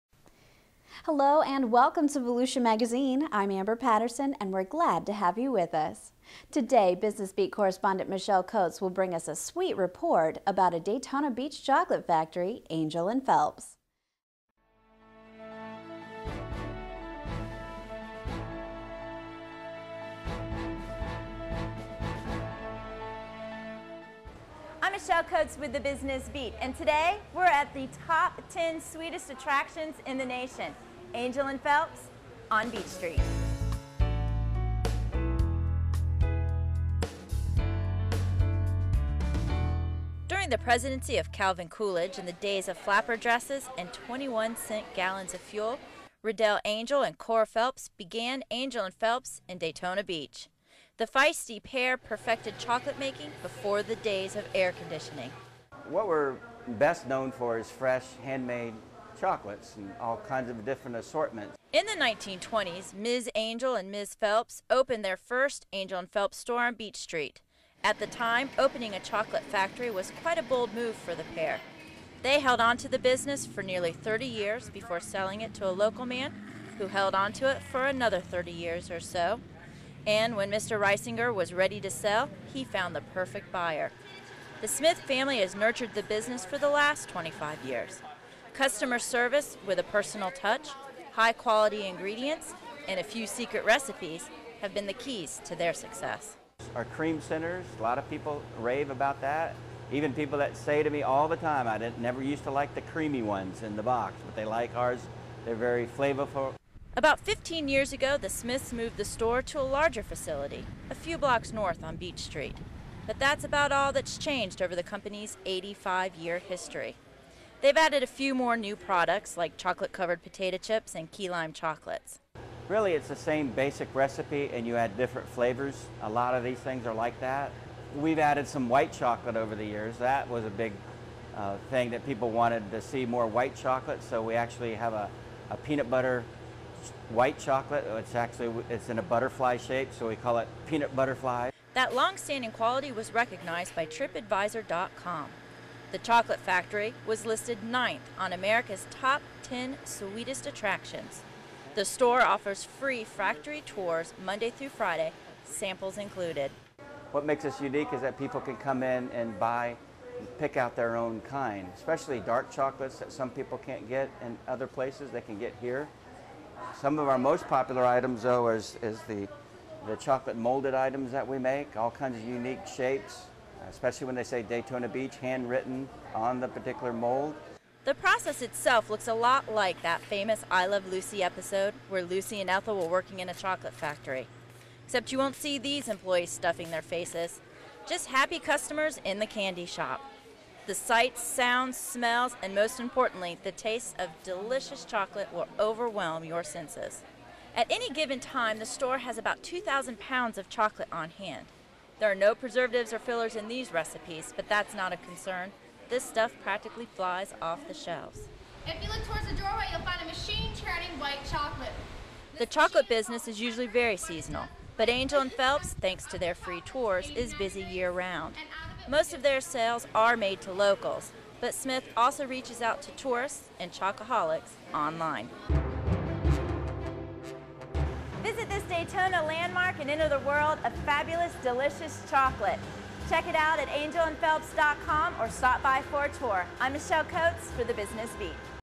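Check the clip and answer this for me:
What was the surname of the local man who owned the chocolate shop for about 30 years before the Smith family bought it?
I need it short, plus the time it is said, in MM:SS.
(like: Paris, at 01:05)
Reisinger, at 01:20.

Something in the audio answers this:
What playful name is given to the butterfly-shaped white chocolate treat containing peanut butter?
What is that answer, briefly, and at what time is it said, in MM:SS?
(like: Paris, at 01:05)
peanut butterfly, at 02:20.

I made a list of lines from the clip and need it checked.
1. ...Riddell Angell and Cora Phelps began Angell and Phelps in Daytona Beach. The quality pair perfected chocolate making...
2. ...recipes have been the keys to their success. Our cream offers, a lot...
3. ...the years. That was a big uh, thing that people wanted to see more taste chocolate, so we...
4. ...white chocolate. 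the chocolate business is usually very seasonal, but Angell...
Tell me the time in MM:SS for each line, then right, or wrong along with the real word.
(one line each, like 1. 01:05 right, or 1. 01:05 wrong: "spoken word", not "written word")
1. 00:46 wrong: "feisty", not "quality"
2. 01:33 wrong: "centers", not "offers"
3. 02:09 wrong: "white", not "taste"
4. 03:30 right.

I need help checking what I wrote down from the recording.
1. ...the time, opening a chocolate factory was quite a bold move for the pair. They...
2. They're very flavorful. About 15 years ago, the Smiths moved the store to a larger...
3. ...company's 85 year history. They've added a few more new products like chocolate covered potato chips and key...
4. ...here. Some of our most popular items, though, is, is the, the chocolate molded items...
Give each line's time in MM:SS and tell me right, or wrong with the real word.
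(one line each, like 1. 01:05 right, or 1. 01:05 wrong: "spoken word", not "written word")
1. 01:07 right
2. 01:45 right
3. 01:54 right
4. 02:45 right.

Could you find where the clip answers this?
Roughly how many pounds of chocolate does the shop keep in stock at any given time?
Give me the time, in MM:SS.
03:19.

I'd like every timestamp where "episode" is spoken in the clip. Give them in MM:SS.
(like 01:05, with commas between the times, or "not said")
03:01.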